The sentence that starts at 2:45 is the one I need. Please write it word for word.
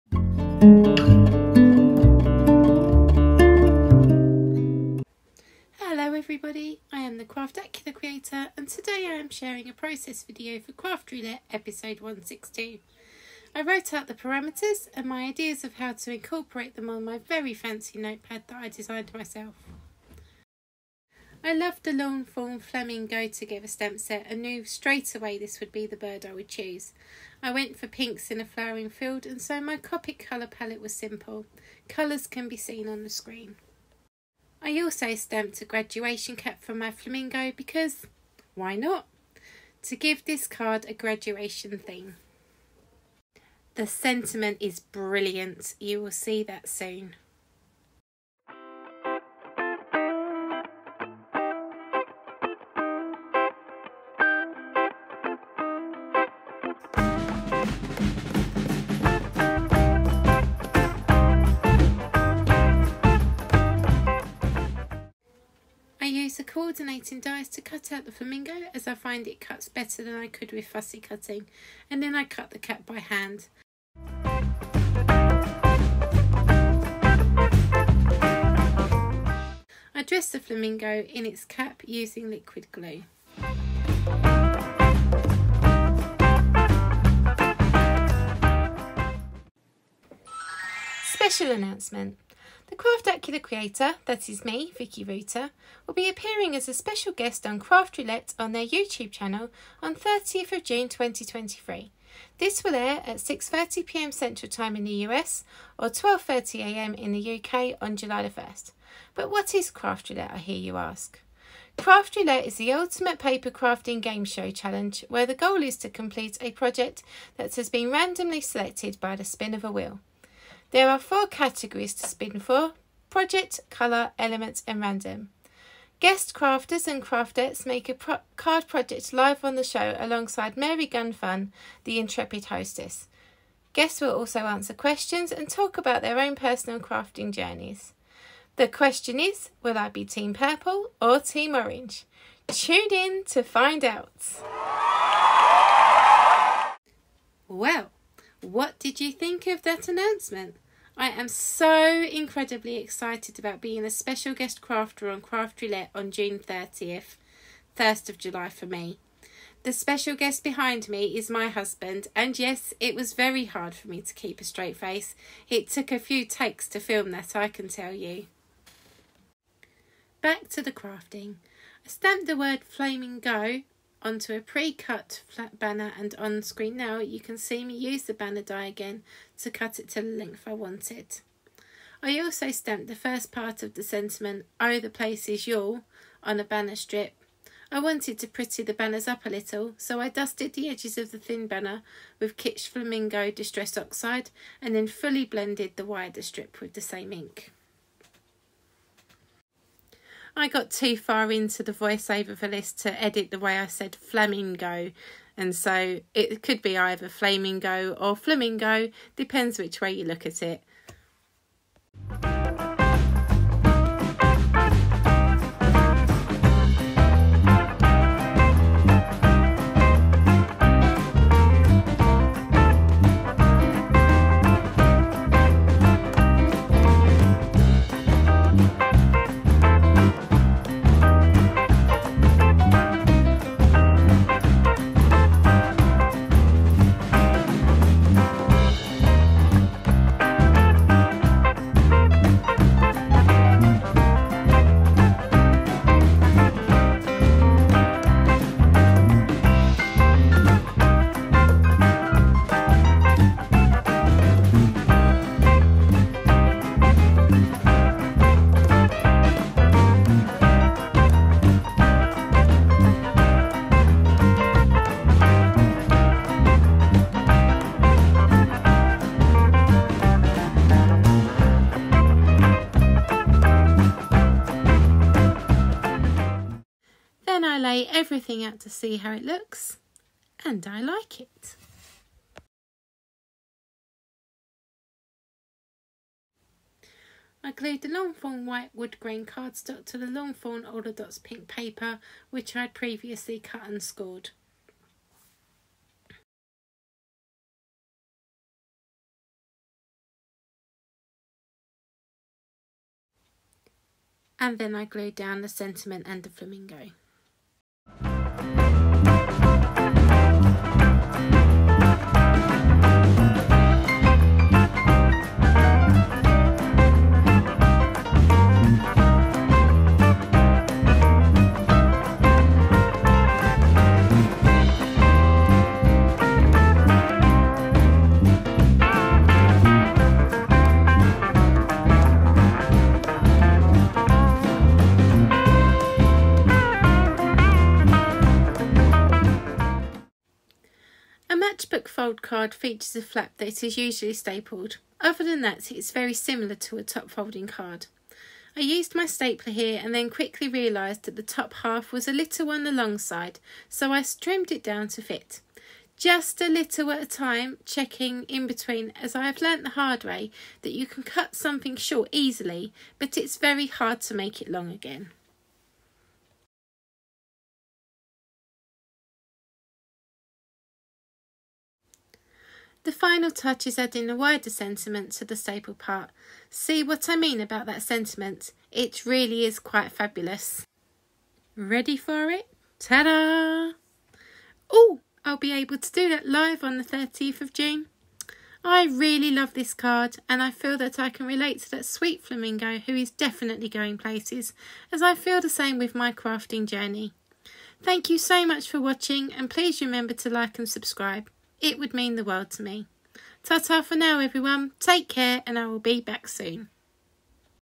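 It took a few takes to film that, I can tell you.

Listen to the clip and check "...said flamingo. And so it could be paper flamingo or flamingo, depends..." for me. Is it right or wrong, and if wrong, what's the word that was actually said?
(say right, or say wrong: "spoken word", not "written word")
wrong: "either", not "paper".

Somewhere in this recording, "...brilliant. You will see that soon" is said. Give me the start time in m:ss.
0:44.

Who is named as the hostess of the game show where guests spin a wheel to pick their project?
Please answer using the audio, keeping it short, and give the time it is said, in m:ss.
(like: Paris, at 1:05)
Mary Gunfun, at 2:10.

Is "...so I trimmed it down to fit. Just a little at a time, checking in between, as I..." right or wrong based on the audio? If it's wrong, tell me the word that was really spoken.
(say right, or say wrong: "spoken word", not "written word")
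right.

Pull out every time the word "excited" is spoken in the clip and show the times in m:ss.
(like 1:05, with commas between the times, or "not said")
2:32.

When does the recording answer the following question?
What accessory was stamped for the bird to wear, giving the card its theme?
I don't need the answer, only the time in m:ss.
0:35.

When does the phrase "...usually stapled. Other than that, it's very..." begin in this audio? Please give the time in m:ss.
5:43.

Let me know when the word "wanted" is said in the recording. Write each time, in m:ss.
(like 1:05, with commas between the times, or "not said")
3:00, 3:07.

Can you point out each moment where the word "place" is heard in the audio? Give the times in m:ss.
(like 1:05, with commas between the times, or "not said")
1:06, 3:04, 6:33.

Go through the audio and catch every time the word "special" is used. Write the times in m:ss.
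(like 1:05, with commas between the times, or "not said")
1:31, 1:36, 2:33, 2:39.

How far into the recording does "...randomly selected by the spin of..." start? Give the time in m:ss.
1:57.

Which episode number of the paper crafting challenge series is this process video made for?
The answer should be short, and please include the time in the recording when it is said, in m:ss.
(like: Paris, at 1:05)
162, at 0:12.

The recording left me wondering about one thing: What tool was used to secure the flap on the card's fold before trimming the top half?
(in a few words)
stapler.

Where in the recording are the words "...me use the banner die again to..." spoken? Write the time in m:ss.
2:57.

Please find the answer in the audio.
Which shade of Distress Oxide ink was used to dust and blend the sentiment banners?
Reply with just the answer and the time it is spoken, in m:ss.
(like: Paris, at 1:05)
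Kitsch Flamingo, at 3:12.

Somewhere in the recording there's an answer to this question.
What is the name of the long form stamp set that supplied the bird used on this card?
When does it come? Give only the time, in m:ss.
0:22.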